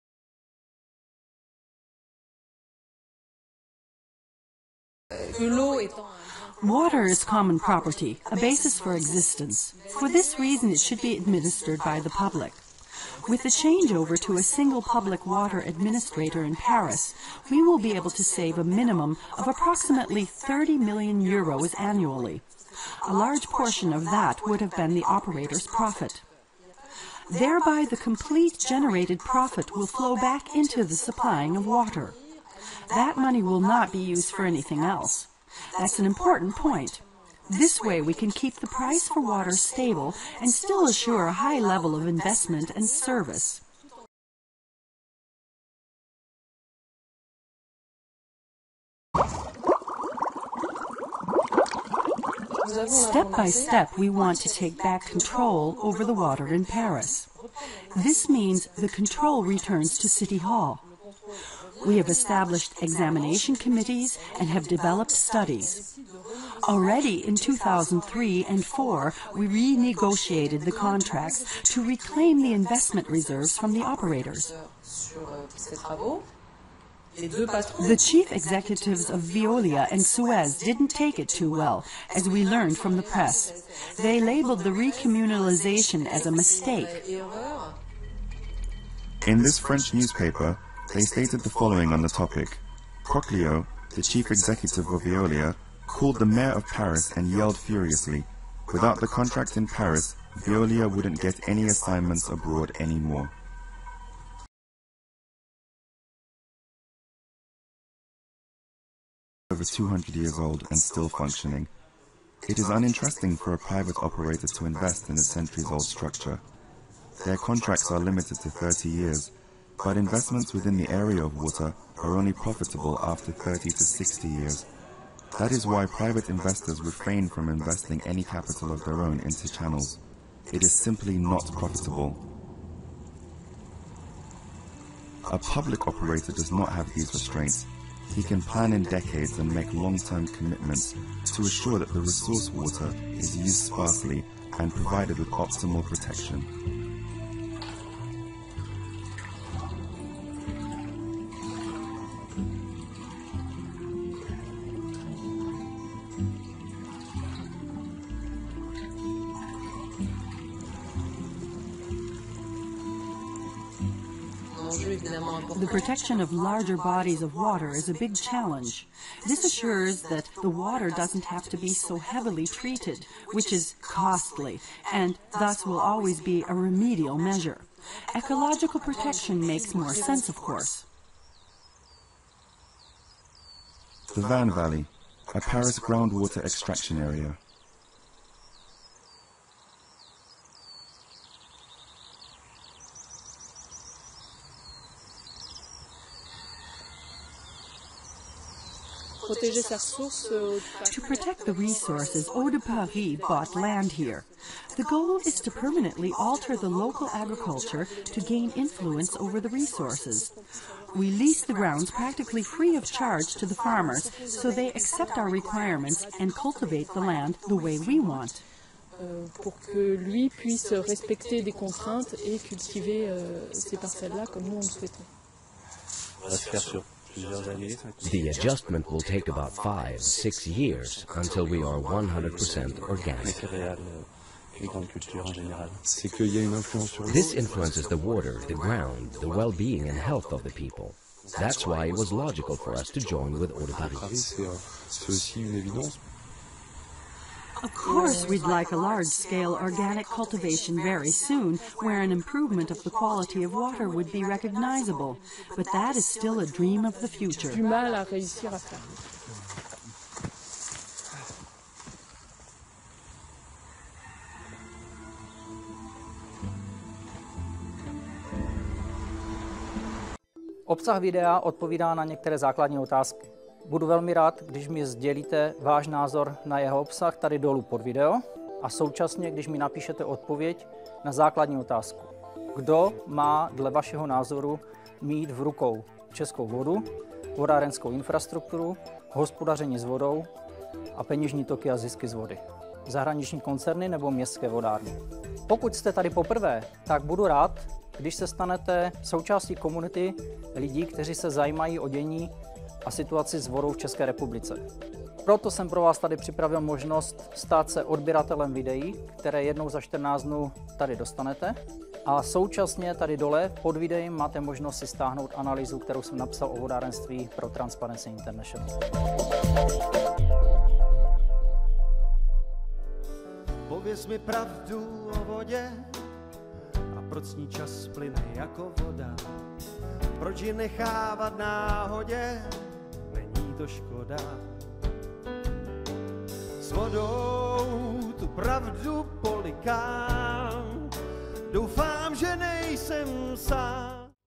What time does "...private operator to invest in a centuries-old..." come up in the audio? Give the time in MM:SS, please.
01:53.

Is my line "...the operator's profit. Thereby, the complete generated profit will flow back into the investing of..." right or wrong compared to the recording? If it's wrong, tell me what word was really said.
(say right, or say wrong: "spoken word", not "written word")
wrong: "supplying", not "investing".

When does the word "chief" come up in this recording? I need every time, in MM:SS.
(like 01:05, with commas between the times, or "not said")
01:17, 01:34.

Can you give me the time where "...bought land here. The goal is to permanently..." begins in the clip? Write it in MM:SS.
03:23.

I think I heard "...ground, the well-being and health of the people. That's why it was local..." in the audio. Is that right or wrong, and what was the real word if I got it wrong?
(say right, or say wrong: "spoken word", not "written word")
wrong: "logical", not "local".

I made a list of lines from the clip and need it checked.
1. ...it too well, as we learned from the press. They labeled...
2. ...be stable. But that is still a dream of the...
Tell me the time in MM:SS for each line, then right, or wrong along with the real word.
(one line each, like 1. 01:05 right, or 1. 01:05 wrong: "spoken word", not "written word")
1. 01:21 right
2. 04:14 wrong: "recognizable", not "stable".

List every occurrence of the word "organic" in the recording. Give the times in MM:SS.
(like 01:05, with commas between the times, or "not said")
03:52, 04:09.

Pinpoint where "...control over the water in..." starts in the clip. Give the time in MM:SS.
00:55.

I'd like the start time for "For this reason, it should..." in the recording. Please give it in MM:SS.
00:09.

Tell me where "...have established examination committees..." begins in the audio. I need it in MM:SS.
01:01.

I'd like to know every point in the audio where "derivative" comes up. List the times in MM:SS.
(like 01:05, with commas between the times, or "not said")
not said.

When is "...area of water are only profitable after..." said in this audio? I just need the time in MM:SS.
02:00.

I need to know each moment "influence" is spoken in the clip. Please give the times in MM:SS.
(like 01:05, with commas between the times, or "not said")
03:28, 03:57.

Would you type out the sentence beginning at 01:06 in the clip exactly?
Already in 2003 and 4, we renegotiated the contracts to reclaim the investment reserves from the operators.